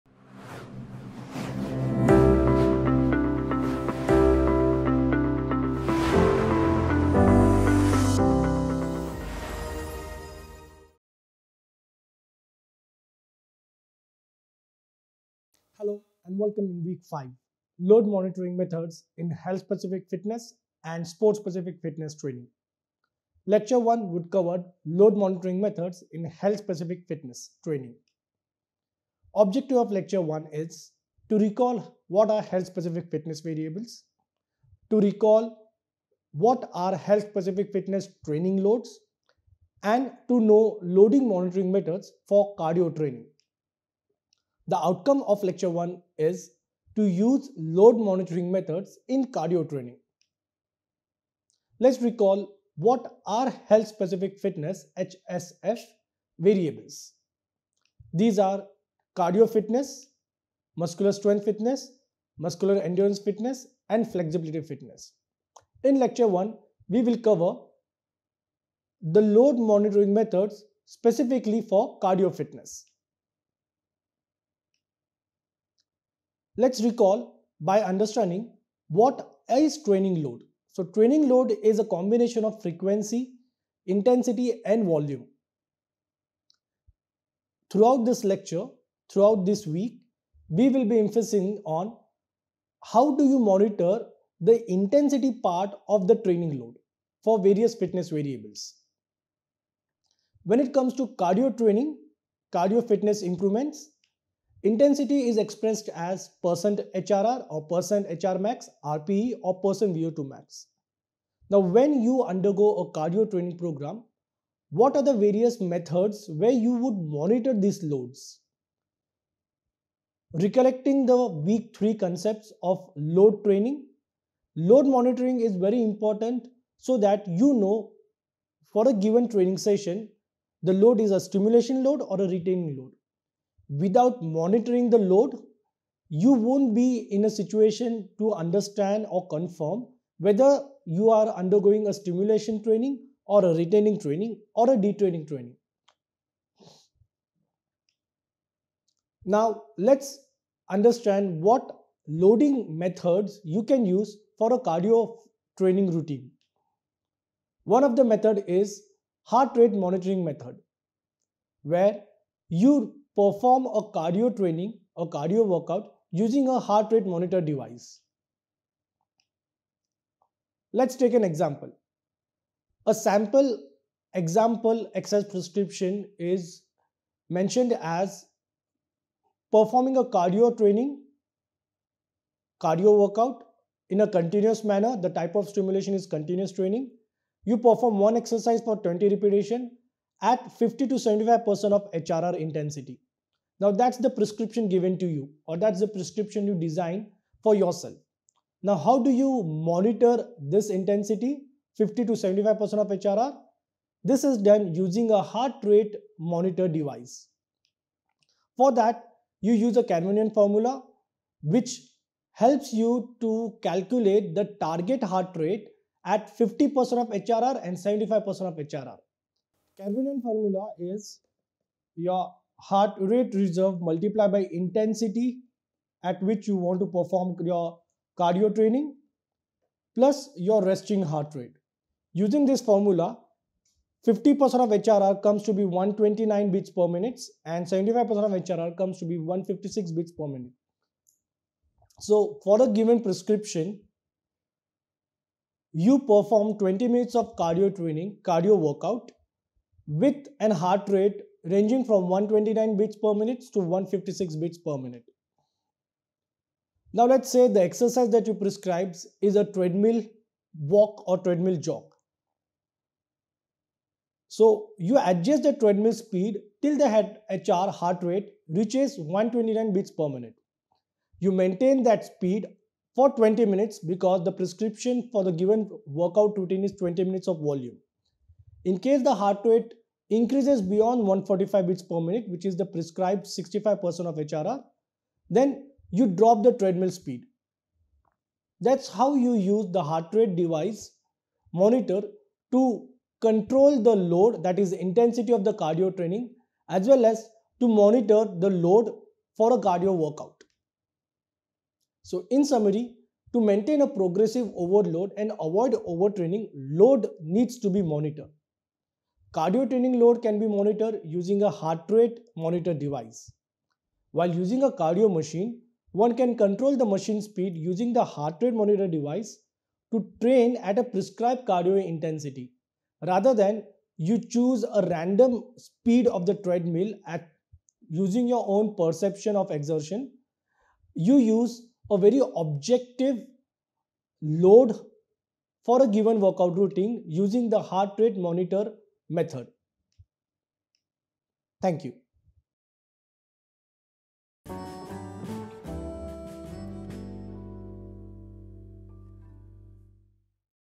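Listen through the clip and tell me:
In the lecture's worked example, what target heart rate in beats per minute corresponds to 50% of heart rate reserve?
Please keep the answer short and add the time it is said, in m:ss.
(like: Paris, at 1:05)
129, at 3:55.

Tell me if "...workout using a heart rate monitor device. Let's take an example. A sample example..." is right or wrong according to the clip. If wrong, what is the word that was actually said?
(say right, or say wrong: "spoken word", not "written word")
right.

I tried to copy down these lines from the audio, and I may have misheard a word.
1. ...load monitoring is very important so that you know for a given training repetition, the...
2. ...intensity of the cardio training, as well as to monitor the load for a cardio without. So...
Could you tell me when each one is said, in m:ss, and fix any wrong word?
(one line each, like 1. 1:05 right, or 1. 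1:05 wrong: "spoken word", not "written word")
1. 2:04 wrong: "session", not "repetition"
2. 4:54 wrong: "workout", not "without".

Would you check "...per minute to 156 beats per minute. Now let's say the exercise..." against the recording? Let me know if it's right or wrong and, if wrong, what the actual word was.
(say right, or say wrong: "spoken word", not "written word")
right.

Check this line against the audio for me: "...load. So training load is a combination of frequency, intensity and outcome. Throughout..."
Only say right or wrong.
wrong.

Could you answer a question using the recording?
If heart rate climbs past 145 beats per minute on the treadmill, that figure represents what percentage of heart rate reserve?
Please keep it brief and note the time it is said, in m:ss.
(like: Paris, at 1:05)
65%, at 4:43.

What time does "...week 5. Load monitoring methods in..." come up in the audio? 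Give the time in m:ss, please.
0:16.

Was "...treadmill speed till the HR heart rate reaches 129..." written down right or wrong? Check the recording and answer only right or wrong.
right.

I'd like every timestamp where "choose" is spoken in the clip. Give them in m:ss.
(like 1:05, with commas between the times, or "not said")
5:24.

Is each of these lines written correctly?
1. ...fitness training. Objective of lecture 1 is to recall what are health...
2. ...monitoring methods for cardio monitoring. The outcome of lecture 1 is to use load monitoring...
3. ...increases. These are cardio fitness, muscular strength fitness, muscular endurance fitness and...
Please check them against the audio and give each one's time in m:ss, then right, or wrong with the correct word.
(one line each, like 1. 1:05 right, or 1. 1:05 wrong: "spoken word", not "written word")
1. 0:27 right
2. 0:41 wrong: "training", not "monitoring"
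3. 0:56 wrong: "variables", not "increases".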